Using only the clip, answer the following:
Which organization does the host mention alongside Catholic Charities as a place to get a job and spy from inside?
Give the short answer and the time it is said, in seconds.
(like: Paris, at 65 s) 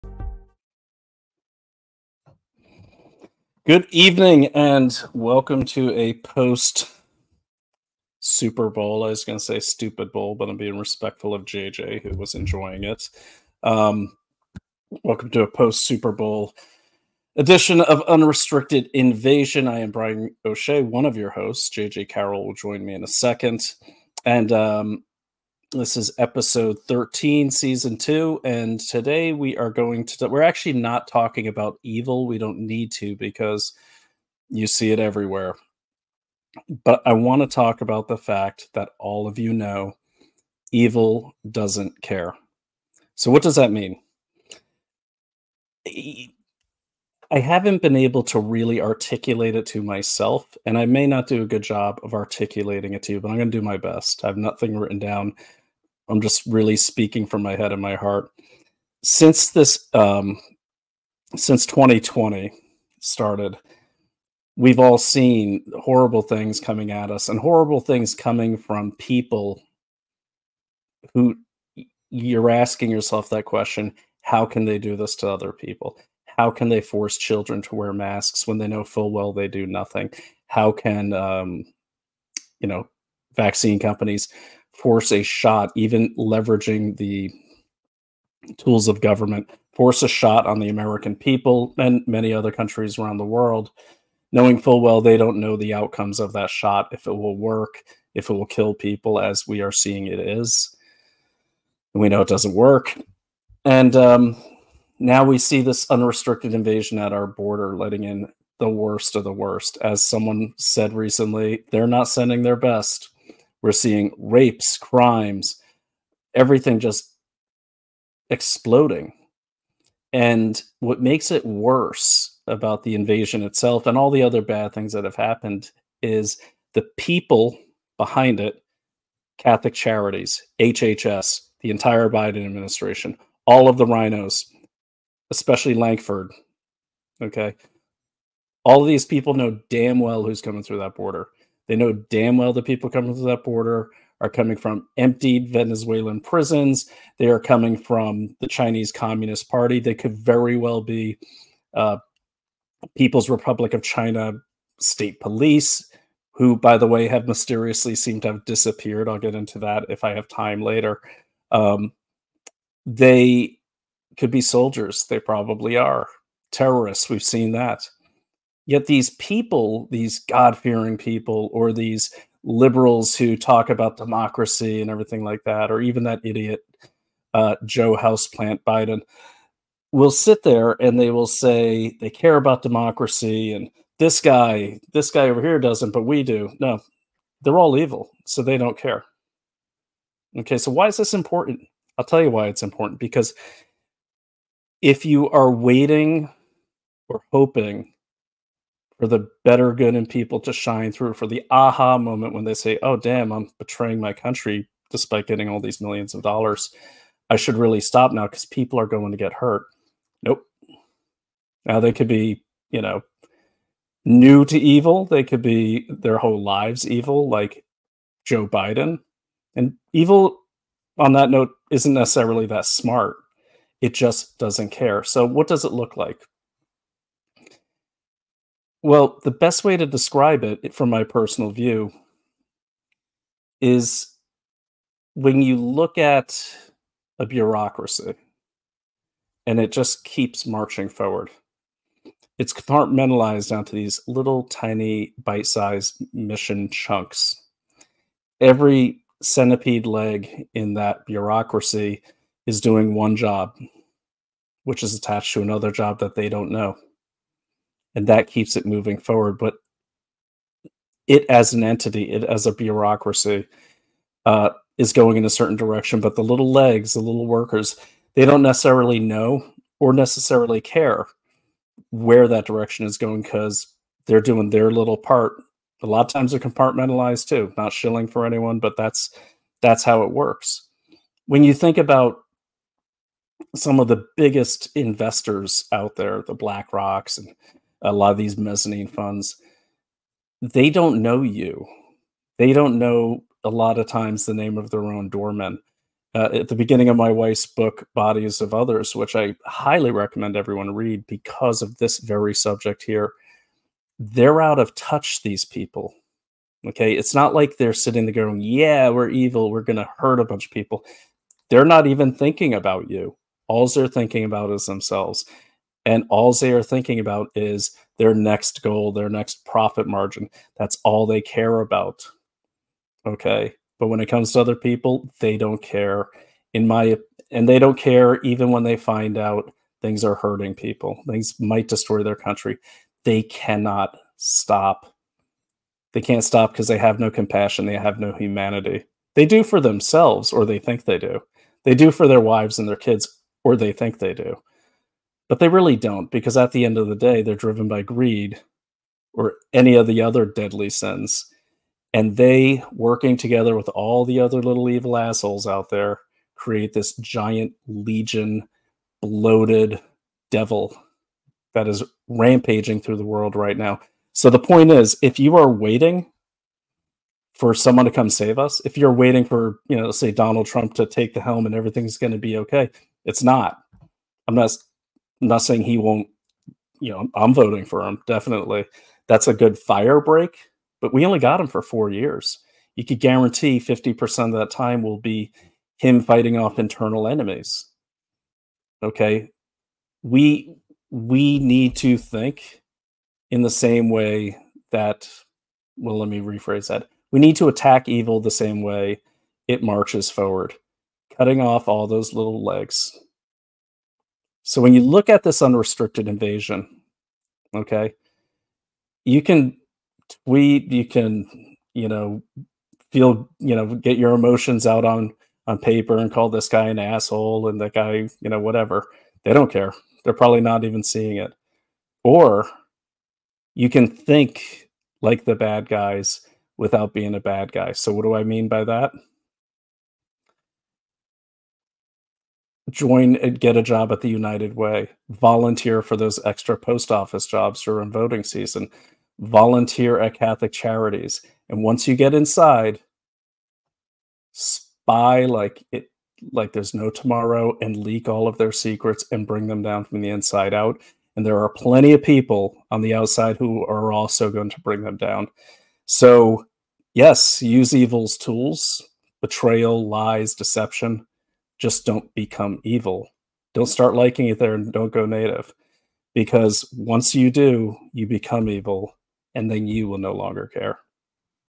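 United Way, at 434 s.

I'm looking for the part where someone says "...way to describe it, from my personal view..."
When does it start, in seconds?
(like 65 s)
229 s.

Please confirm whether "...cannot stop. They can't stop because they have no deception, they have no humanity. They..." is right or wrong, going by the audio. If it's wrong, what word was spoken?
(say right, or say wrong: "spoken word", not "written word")
wrong: "compassion", not "deception".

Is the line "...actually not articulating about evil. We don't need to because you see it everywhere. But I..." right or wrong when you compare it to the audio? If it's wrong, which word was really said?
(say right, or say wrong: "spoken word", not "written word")
wrong: "talking", not "articulating".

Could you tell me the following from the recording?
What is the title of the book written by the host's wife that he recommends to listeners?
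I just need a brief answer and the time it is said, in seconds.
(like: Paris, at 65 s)
Bodies of Others, at 297 s.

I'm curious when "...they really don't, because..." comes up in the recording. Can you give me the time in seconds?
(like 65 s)
345 s.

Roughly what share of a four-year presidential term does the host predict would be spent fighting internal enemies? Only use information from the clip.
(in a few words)
50%.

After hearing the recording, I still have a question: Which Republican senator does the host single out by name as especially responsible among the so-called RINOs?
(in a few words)
Lankford.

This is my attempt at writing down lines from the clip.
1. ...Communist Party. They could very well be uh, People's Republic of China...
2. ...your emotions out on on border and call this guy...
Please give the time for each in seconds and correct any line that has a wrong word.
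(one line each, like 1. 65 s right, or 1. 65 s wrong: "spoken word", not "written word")
1. 148 s right
2. 413 s wrong: "paper", not "border".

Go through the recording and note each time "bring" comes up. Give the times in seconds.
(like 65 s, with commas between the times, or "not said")
449 s, 454 s.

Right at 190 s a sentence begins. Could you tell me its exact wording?
Okay, so why is this important?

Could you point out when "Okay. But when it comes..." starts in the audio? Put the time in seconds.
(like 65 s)
323 s.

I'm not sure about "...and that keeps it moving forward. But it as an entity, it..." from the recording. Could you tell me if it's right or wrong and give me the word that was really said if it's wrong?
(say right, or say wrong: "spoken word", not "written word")
right.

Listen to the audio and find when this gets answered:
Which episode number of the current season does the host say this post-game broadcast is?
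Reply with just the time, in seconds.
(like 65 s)
26 s.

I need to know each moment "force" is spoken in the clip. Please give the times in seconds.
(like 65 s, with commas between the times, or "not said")
76 s, 84 s, 89 s.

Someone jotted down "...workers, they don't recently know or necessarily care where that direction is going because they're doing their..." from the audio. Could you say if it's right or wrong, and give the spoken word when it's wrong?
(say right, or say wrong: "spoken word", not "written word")
wrong: "necessarily", not "recently".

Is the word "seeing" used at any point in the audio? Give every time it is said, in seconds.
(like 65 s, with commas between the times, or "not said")
99 s, 113 s, 420 s.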